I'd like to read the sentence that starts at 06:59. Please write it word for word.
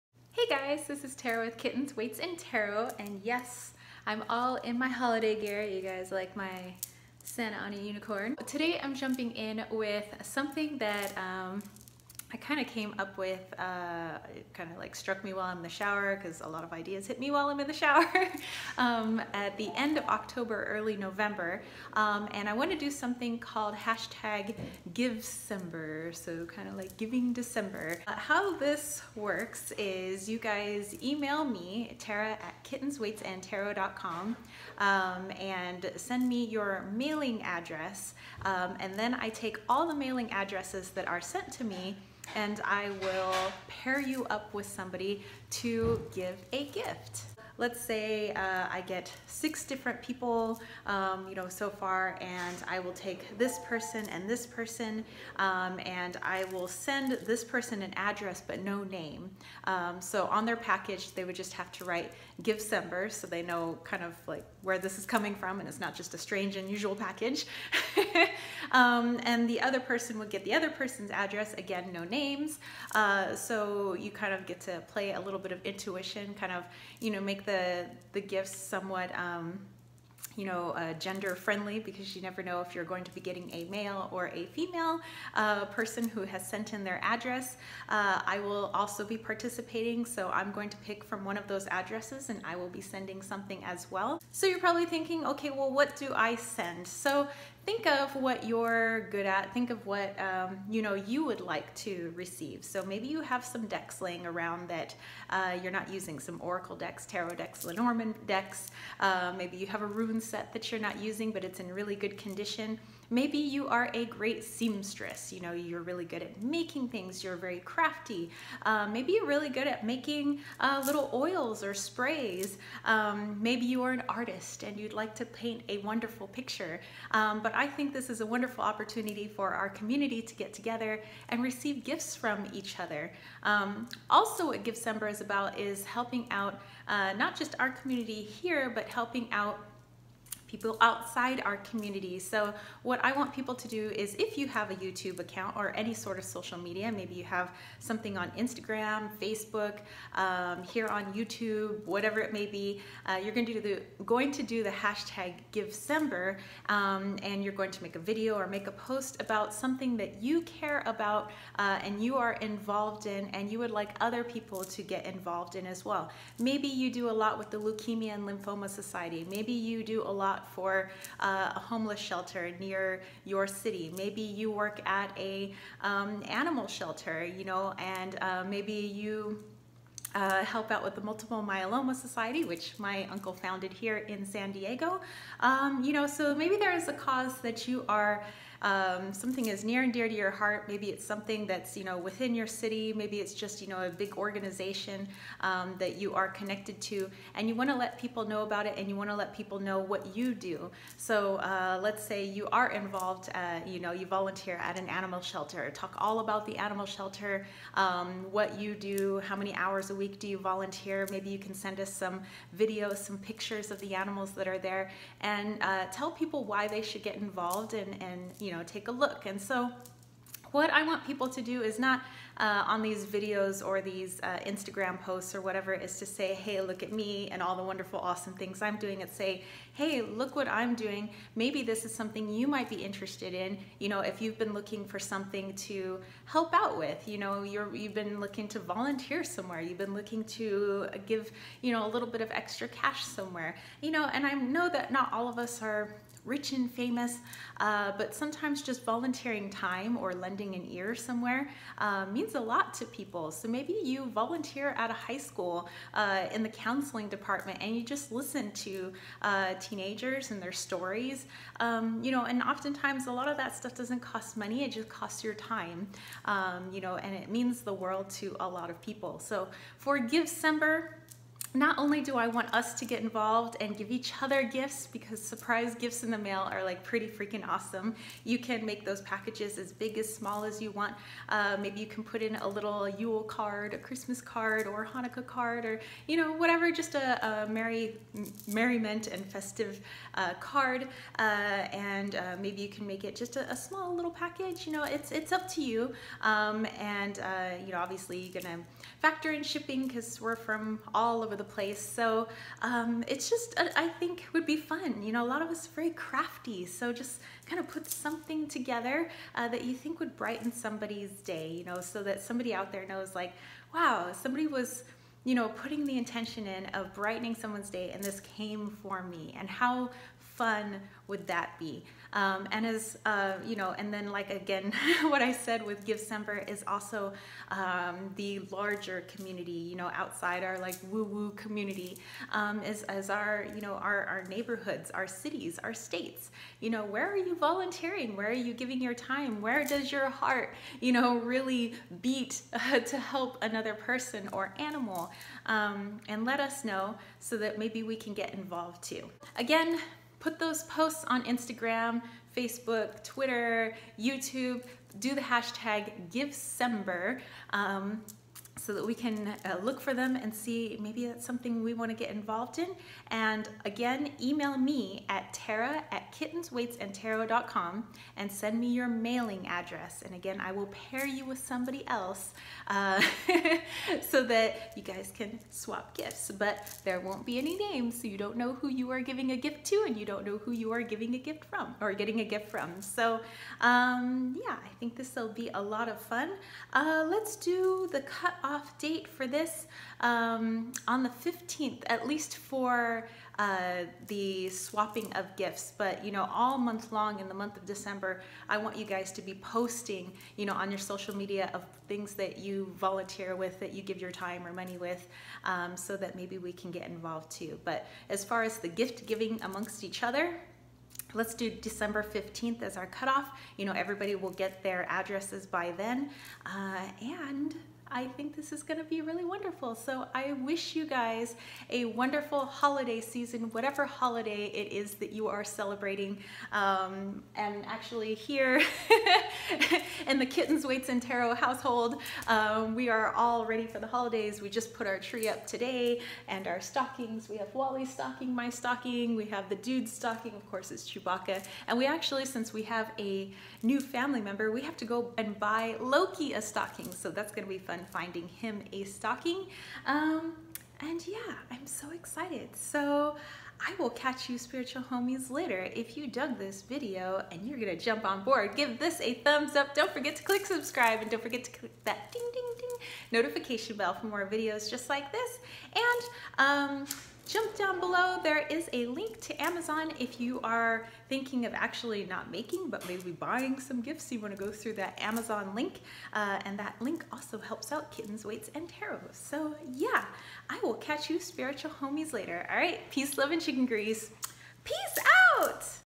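So I wish you guys a wonderful holiday season, whatever holiday it is that you are celebrating.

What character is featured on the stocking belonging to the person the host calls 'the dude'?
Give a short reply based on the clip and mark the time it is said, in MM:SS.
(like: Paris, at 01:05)
Chewbacca, at 07:20.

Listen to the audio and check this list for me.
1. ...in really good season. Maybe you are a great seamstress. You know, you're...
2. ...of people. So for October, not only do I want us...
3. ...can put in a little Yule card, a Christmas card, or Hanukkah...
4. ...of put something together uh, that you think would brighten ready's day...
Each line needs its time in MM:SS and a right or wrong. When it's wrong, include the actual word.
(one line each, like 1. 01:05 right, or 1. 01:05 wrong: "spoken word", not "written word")
1. 01:51 wrong: "condition", not "season"
2. 04:28 wrong: "Givecember", not "October"
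3. 04:41 right
4. 05:07 wrong: "somebody", not "ready".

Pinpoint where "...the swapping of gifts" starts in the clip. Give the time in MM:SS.
06:34.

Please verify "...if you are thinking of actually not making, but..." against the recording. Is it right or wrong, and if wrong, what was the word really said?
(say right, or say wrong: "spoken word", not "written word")
right.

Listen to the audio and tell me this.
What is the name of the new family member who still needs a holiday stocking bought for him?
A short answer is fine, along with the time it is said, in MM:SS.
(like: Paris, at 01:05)
Loki, at 07:25.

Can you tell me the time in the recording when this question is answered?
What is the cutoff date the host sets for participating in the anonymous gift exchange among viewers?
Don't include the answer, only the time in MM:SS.
06:51.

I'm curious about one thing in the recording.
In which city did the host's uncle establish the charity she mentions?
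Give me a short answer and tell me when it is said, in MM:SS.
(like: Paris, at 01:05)
San Diego, at 03:04.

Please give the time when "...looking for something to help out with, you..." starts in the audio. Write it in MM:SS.
03:54.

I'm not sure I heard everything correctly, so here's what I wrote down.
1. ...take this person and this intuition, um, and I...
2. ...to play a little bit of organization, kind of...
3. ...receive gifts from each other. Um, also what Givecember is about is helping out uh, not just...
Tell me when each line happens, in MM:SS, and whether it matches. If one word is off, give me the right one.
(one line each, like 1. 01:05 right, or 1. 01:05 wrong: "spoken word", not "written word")
1. 00:52 wrong: "person", not "intuition"
2. 01:14 wrong: "intuition", not "organization"
3. 02:11 right.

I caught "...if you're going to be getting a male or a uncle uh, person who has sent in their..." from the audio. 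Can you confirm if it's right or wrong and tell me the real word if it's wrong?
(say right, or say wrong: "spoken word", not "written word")
wrong: "female", not "uncle".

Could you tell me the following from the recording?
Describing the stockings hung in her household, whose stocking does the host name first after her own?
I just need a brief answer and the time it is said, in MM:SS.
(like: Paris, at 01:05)
Wally, at 07:17.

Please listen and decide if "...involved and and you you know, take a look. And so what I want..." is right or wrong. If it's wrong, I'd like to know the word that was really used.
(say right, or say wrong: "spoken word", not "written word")
right.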